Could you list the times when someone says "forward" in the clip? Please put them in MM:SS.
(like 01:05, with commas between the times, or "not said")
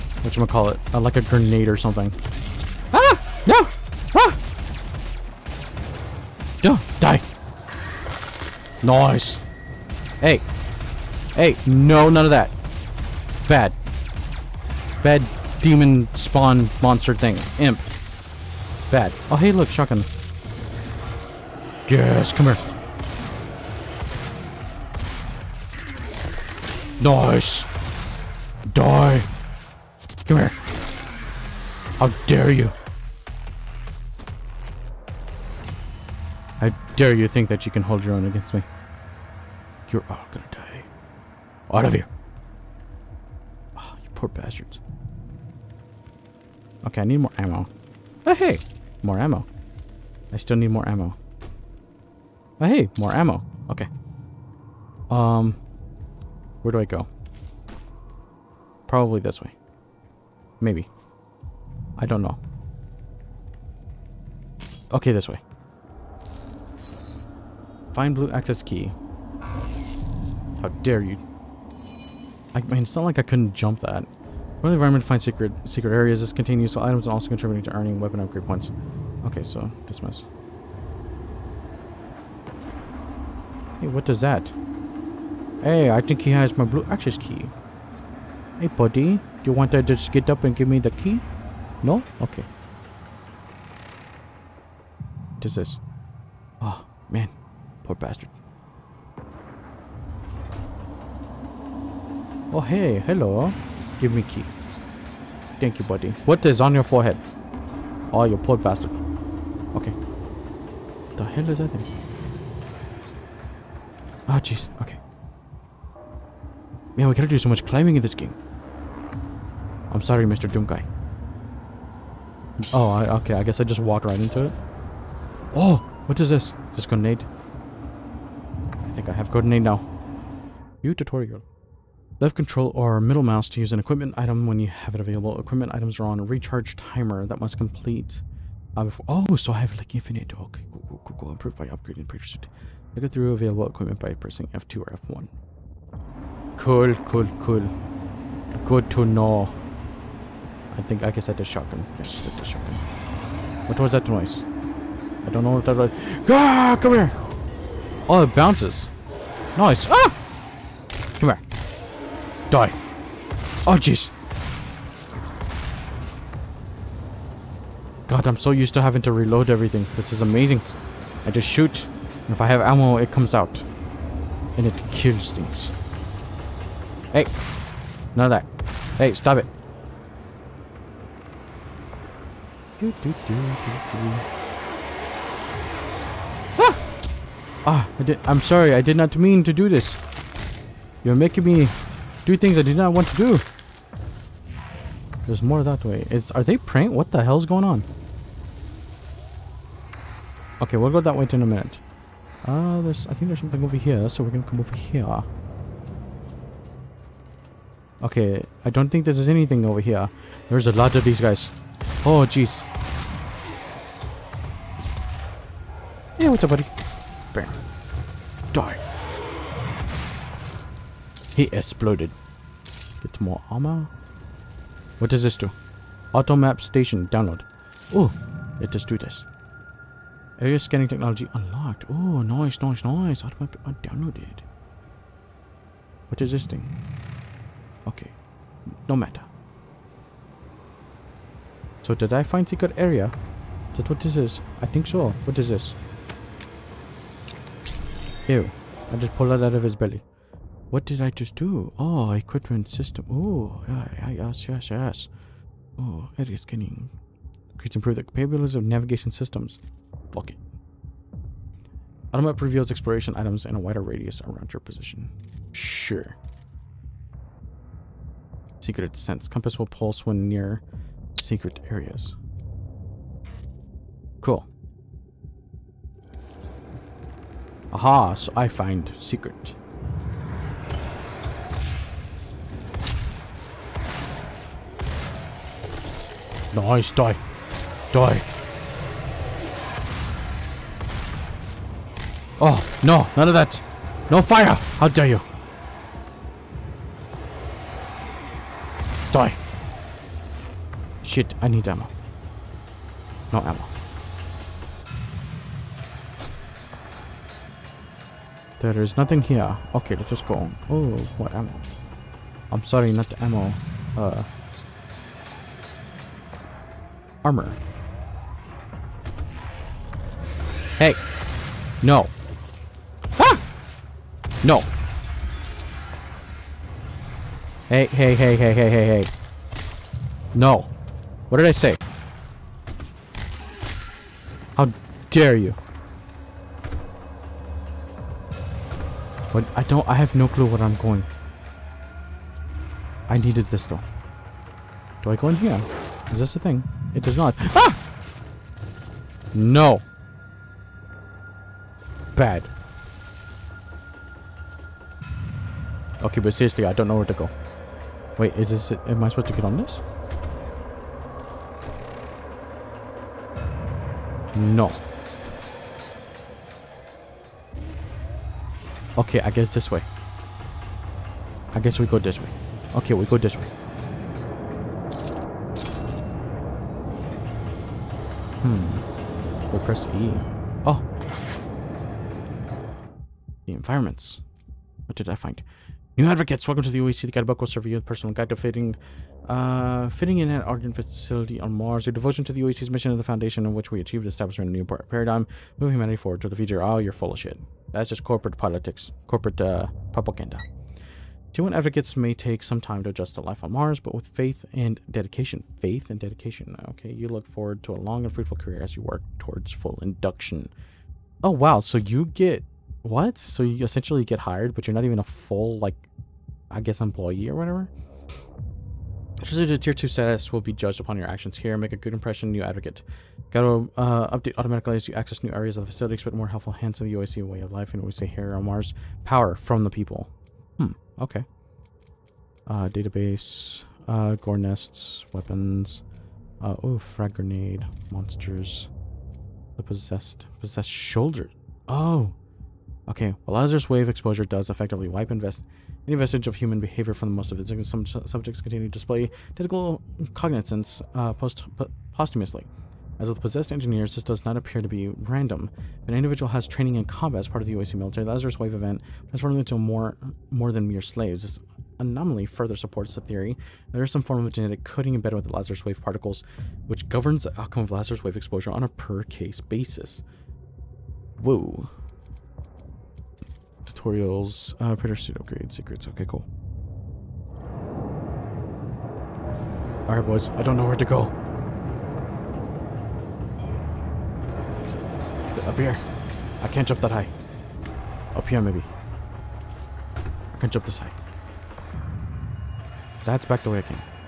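06:35, 06:47.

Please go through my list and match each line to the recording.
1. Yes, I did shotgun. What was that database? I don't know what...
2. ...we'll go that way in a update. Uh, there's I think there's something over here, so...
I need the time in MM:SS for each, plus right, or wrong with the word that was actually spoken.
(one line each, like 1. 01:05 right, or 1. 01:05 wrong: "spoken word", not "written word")
1. 02:31 wrong: "noise", not "database"
2. 03:20 wrong: "minute", not "update".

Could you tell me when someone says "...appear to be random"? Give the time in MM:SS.
07:34.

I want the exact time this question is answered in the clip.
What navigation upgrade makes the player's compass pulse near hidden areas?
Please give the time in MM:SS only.
04:28.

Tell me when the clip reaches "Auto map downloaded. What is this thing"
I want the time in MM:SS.
03:53.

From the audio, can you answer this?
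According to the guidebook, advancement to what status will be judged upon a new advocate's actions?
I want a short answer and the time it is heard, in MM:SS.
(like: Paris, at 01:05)
tier 2, at 06:59.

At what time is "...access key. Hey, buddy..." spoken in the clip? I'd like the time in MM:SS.
01:26.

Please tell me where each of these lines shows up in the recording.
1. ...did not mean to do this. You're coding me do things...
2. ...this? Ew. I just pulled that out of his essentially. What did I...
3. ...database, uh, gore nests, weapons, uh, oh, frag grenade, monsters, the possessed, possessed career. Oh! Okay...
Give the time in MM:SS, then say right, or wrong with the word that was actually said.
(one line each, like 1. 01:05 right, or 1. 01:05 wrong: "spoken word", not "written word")
1. 03:08 wrong: "making", not "coding"
2. 04:05 wrong: "belly", not "essentially"
3. 07:12 wrong: "shoulder", not "career".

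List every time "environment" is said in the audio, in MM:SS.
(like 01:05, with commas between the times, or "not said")
01:14, 06:23.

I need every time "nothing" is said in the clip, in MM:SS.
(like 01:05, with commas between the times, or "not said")
05:08.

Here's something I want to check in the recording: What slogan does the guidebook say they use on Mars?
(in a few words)
Power from the people.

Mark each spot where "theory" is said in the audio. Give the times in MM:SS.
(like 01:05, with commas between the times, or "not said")
07:43.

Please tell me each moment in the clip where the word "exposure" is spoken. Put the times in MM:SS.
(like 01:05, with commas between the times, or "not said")
07:23, 07:48.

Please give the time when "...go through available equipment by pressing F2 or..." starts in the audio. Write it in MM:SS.
02:23.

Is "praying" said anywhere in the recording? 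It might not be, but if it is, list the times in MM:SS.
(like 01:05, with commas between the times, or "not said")
03:16.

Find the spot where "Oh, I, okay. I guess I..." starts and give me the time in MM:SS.
02:02.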